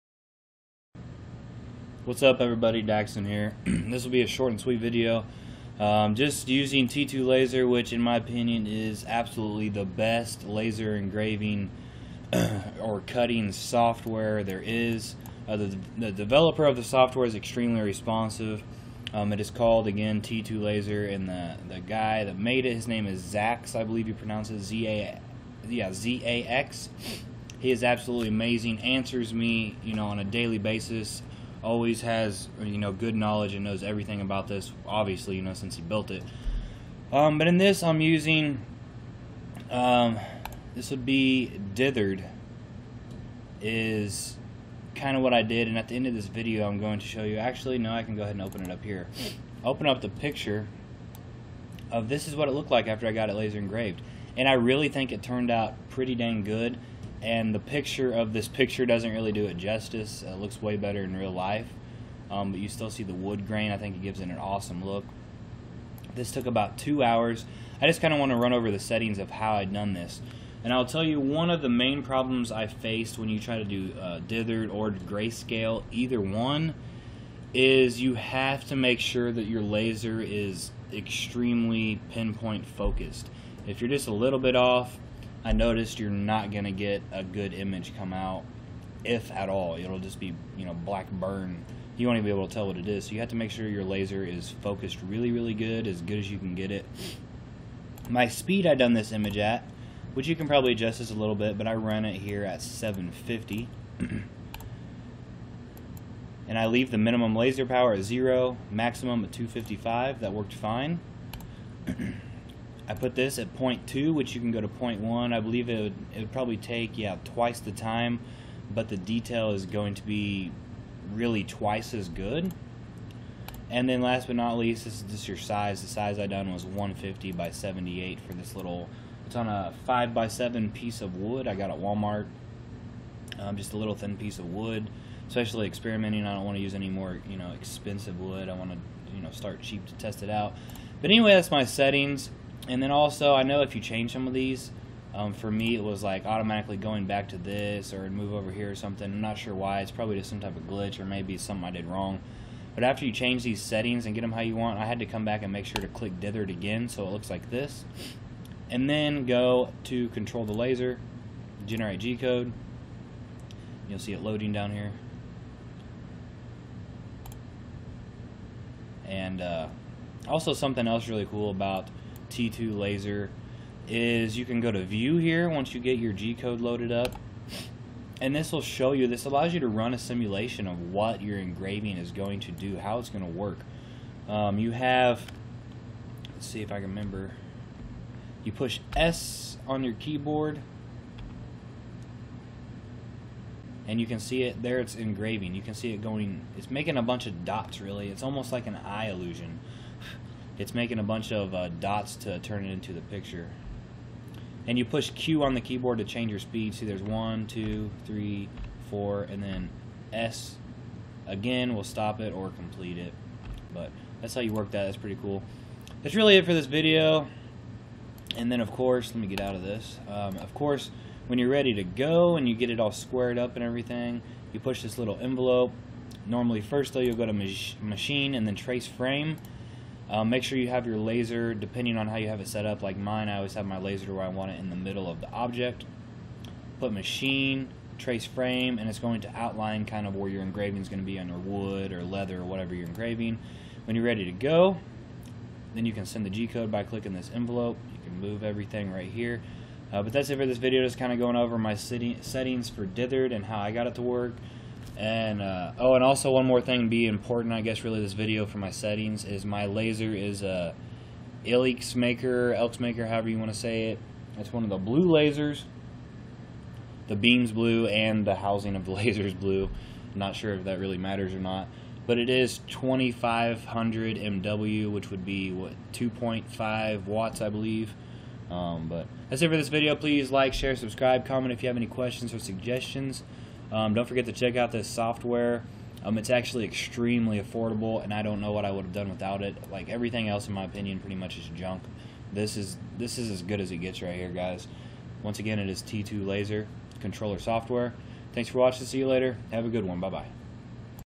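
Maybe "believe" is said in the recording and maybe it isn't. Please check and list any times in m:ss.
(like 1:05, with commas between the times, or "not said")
0:23, 1:55, 4:37.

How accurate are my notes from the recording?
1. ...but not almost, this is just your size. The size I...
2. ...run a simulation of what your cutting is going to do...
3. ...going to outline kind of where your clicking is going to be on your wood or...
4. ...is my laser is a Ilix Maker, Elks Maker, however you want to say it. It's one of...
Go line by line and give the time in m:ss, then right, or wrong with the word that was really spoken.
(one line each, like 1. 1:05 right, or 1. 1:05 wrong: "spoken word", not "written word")
1. 2:04 wrong: "least", not "almost"
2. 2:59 wrong: "engraving", not "cutting"
3. 3:58 wrong: "engraving", not "clicking"
4. 4:19 right.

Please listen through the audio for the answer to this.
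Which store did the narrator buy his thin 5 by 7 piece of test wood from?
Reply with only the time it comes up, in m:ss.
2:11.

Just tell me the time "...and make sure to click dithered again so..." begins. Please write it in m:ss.
2:35.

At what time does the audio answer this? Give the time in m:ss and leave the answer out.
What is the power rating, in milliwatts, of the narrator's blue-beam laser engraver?
4:32.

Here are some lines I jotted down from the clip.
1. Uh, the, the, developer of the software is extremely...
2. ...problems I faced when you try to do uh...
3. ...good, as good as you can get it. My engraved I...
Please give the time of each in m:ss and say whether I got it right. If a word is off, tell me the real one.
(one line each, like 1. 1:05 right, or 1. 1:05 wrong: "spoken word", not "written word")
1. 0:15 right
2. 1:12 right
3. 1:35 wrong: "speed", not "engraved".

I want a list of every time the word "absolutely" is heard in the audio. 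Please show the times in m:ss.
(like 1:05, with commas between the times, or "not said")
0:09, 0:27.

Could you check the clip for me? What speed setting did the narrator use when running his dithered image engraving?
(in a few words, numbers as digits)
750.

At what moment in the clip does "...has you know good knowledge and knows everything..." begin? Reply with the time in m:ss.
0:32.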